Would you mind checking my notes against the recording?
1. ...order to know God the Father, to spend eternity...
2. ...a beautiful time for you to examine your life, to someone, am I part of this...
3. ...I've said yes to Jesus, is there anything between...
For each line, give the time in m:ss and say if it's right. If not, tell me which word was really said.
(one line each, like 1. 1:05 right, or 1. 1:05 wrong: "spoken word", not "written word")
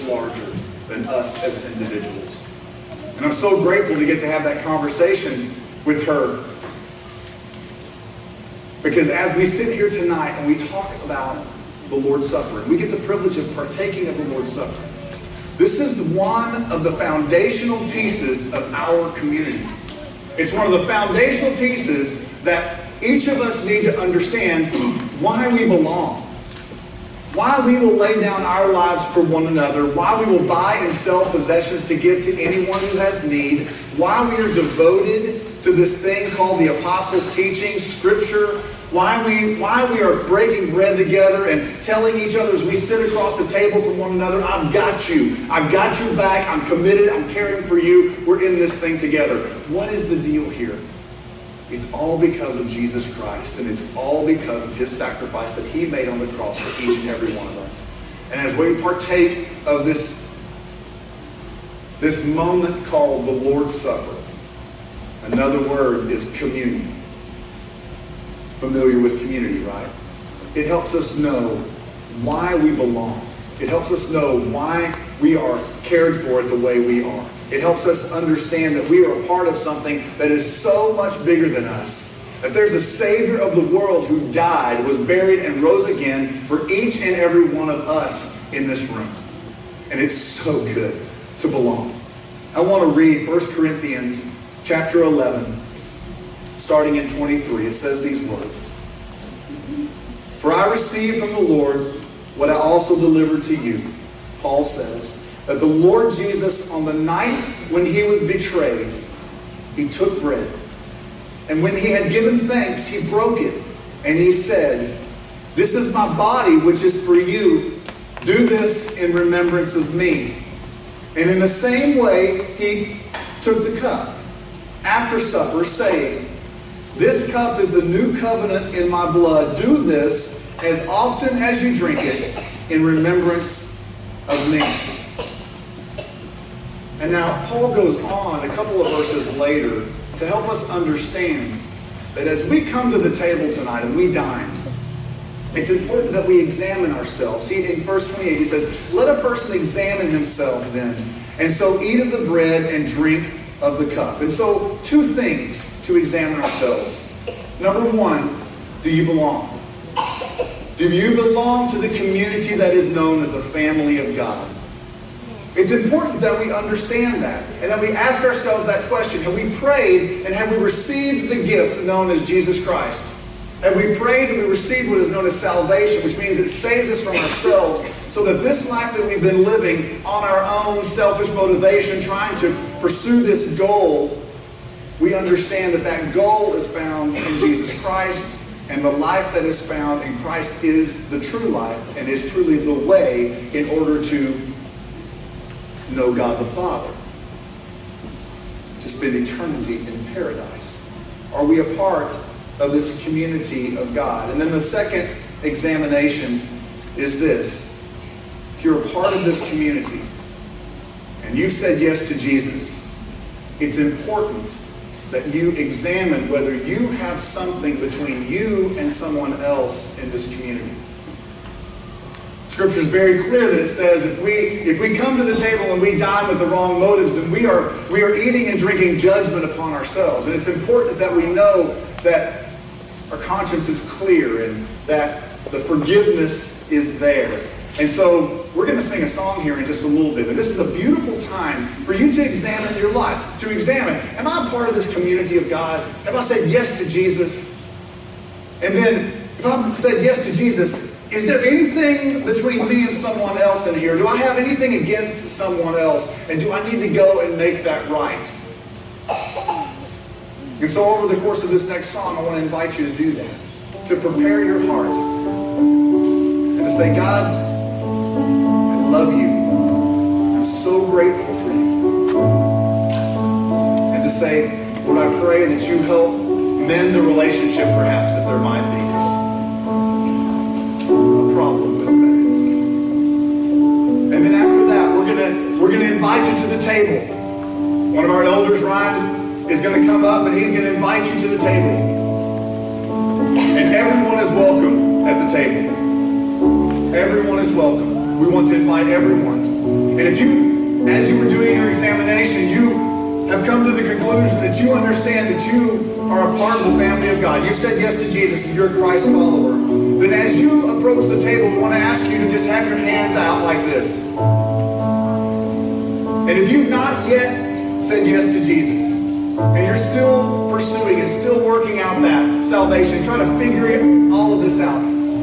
1. 3:13 right
2. 4:00 wrong: "examine", not "someone"
3. 4:09 right.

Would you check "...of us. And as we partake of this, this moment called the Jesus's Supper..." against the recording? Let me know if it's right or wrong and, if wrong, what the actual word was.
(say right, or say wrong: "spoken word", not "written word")
wrong: "Lord", not "Jesus".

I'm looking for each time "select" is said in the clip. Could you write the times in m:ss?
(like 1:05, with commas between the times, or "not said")
not said.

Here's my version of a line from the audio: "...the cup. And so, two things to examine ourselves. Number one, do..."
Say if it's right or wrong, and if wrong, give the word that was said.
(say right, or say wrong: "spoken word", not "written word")
right.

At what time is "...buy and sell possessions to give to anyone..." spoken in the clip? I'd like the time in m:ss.
0:30.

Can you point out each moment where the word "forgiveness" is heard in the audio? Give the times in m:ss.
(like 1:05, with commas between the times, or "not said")
3:55.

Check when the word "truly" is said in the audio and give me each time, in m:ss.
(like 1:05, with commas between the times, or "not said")
3:12.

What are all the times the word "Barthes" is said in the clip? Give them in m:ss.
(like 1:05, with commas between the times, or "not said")
not said.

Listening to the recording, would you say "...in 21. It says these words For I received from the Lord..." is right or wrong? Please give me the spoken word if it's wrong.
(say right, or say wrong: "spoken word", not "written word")
wrong: "23", not "21".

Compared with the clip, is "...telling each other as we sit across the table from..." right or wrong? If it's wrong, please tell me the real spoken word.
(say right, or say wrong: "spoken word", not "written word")
right.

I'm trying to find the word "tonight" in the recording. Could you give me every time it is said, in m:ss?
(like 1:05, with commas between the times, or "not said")
0:09, 2:23.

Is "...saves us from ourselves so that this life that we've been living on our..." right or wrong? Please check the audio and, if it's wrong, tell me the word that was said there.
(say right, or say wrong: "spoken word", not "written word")
right.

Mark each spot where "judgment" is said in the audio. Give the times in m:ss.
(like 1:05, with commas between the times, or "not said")
3:48.